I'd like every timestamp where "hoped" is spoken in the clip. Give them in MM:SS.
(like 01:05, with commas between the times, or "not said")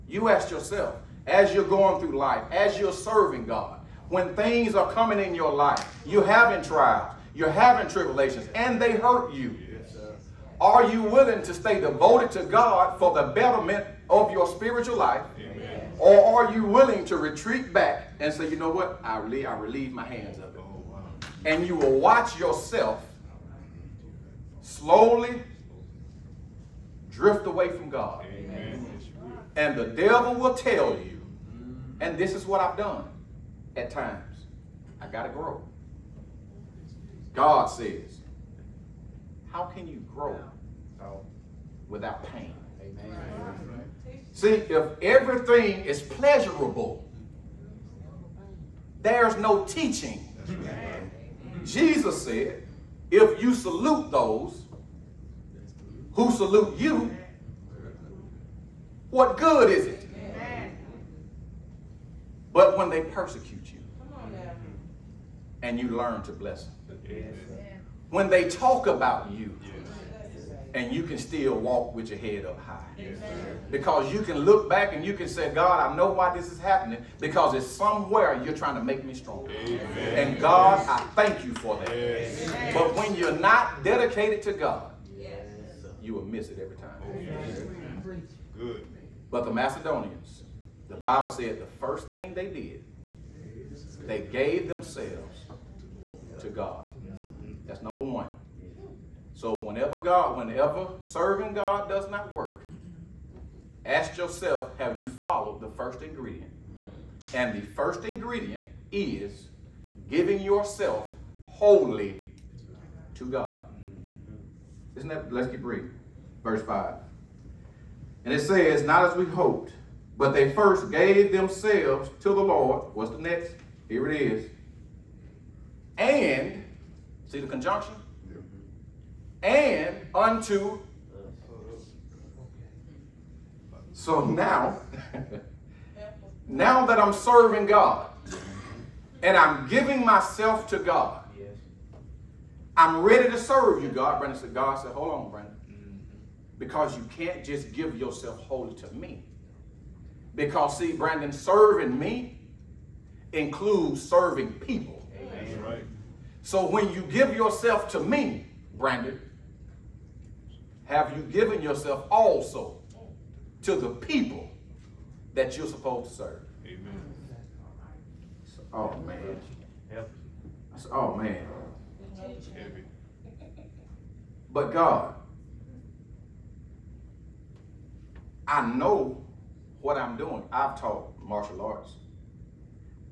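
01:59.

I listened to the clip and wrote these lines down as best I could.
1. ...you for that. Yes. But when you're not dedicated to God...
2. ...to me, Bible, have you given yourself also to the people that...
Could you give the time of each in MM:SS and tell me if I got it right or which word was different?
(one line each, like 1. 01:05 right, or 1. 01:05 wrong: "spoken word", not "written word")
1. 01:21 right
2. 02:37 wrong: "Brandon", not "Bible".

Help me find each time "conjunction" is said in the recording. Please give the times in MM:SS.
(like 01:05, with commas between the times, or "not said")
02:07.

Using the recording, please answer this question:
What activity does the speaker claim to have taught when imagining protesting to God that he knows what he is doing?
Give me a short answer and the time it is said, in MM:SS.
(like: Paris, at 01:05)
Martial arts, at 03:01.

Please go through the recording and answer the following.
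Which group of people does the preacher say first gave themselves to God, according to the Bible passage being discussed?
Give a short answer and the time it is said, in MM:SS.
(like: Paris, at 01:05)
The Macedonians, at 01:29.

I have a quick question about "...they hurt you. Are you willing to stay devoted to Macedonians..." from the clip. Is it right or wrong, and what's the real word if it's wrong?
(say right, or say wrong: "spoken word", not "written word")
wrong: "God", not "Macedonians".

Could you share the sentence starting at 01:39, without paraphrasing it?
So whenever God, whenever serving God does not work, ask yourself, have you followed the first ingredient?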